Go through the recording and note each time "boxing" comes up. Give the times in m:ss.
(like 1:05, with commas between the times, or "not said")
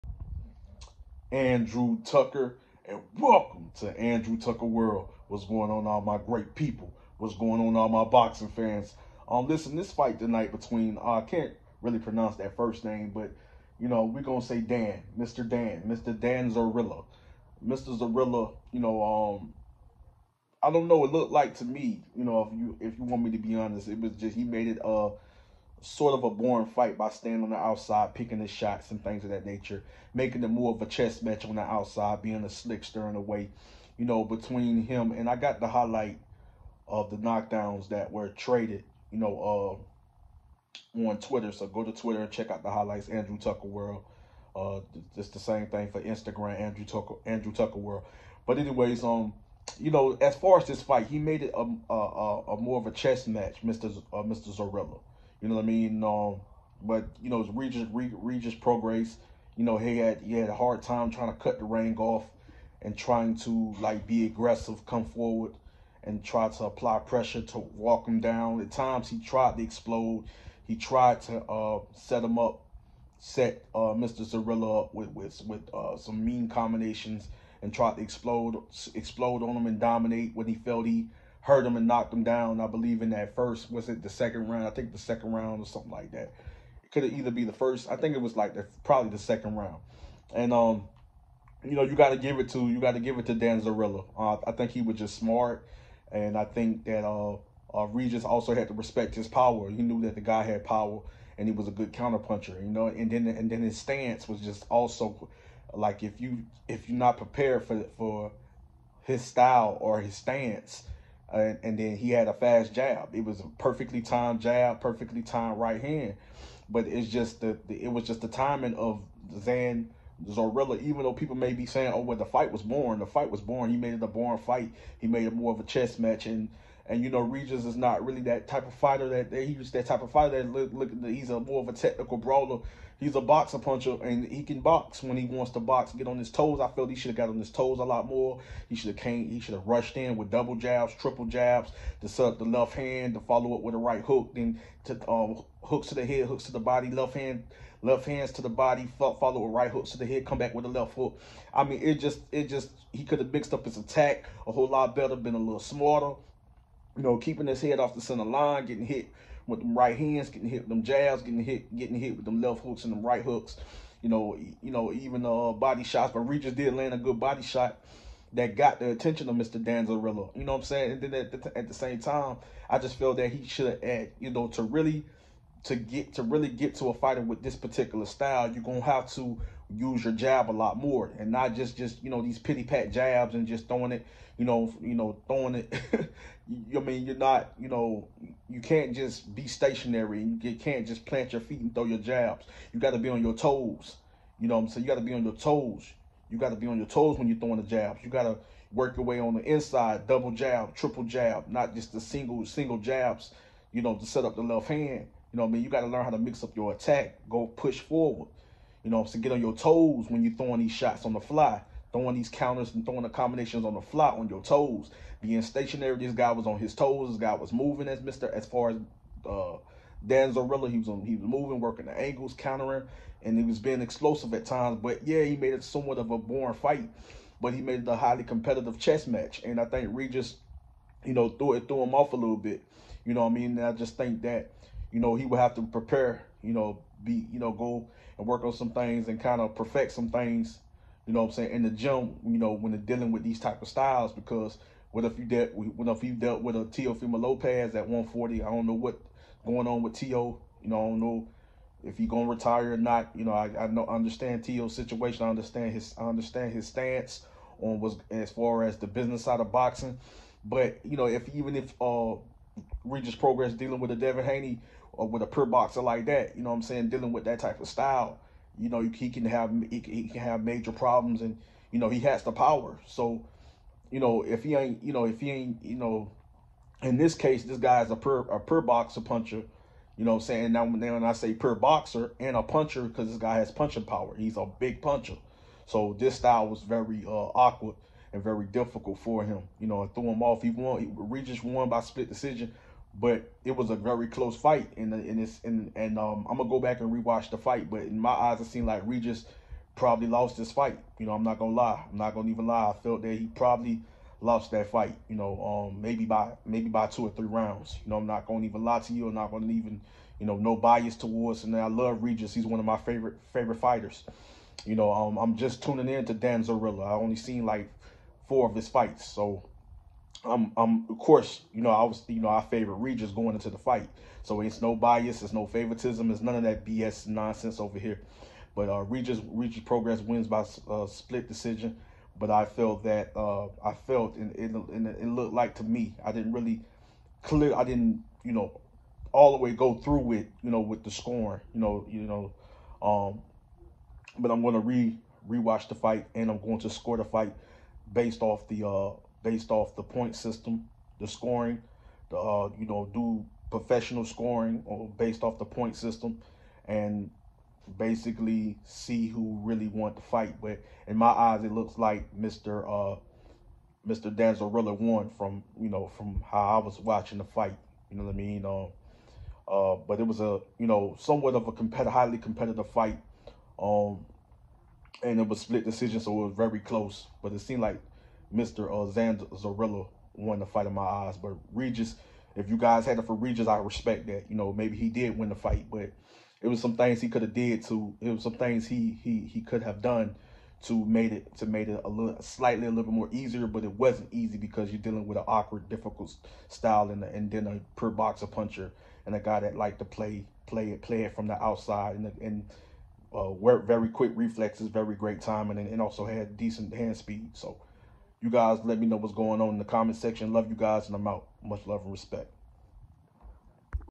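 0:08, 4:19.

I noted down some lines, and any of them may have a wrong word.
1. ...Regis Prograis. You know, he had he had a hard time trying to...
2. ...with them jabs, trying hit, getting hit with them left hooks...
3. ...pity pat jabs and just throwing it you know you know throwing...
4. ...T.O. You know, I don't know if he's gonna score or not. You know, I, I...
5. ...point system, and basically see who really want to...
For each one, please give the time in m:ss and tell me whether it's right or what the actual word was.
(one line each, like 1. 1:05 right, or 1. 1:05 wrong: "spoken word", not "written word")
1. 0:57 right
2. 2:40 wrong: "getting", not "trying"
3. 3:02 right
4. 4:09 wrong: "retire", not "score"
5. 5:55 right.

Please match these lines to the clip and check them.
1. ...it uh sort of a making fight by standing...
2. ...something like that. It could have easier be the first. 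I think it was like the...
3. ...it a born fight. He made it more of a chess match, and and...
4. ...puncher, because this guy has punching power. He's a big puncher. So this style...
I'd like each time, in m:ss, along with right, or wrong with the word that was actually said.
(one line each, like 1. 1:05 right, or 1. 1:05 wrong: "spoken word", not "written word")
1. 0:24 wrong: "boring", not "making"
2. 1:25 wrong: "either", not "easier"
3. 2:03 right
4. 4:42 right.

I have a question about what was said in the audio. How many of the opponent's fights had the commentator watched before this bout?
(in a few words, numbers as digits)
4.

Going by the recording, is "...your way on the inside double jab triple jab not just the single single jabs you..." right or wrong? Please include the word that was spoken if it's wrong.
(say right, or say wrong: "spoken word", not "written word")
right.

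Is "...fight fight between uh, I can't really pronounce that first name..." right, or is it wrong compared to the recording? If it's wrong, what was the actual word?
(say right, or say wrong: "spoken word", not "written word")
wrong: "tonight", not "fight".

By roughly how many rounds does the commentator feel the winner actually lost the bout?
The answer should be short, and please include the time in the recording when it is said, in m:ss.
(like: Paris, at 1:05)
two or three, at 5:06.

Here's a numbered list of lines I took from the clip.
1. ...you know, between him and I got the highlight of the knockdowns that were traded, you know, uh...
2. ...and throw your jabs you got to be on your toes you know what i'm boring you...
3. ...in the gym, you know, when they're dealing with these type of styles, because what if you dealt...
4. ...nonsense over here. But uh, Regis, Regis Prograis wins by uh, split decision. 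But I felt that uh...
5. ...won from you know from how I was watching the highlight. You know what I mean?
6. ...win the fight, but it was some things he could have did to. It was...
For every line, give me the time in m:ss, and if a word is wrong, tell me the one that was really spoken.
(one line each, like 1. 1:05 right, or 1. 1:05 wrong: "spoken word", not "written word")
1. 0:33 right
2. 3:11 wrong: "saying", not "boring"
3. 4:01 right
4. 5:27 right
5. 6:04 wrong: "fight", not "highlight"
6. 6:25 right.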